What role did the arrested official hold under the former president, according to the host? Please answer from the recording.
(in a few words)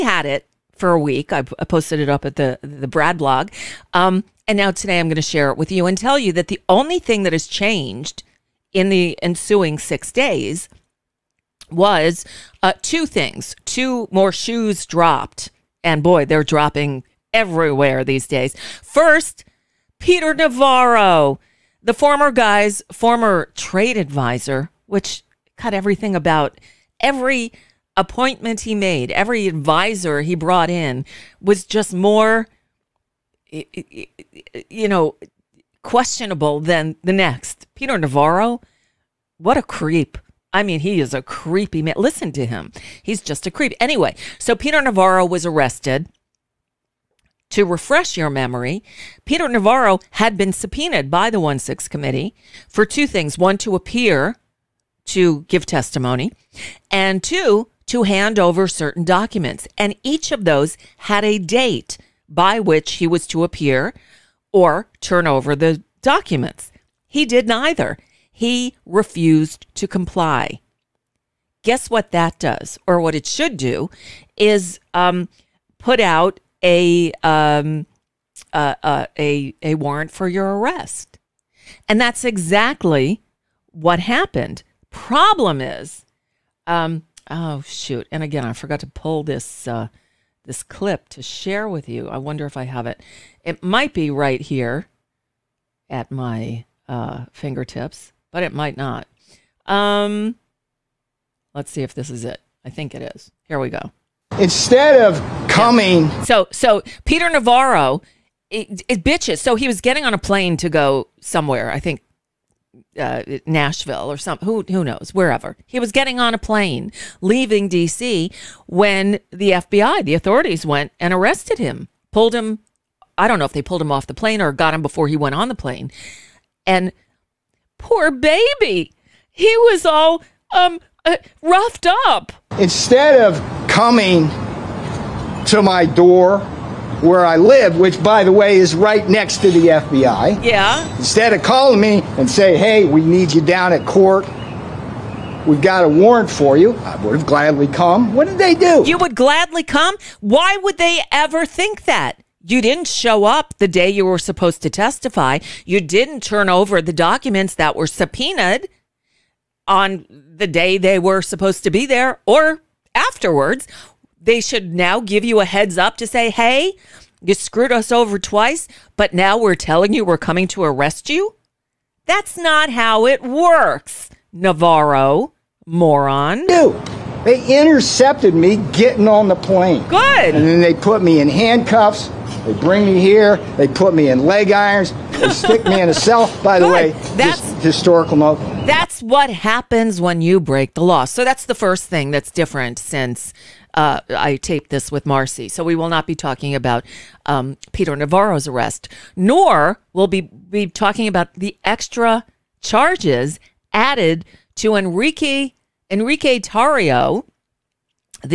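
Trade advisor.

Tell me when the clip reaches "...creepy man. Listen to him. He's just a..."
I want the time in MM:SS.
00:41.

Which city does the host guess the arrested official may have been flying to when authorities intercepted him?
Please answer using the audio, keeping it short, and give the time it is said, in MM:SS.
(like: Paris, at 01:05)
Nashville, at 01:53.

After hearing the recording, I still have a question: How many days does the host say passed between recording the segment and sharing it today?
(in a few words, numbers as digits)
6.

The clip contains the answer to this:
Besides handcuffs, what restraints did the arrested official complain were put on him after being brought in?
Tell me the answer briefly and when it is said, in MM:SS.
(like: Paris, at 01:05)
Leg irons, at 03:04.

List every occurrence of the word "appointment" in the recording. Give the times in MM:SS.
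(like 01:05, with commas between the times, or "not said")
00:27.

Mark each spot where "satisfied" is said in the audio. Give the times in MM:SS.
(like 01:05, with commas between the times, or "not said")
not said.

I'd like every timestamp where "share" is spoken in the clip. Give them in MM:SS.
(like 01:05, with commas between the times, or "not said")
00:05, 01:31.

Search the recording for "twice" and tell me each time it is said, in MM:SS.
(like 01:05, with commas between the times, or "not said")
02:48.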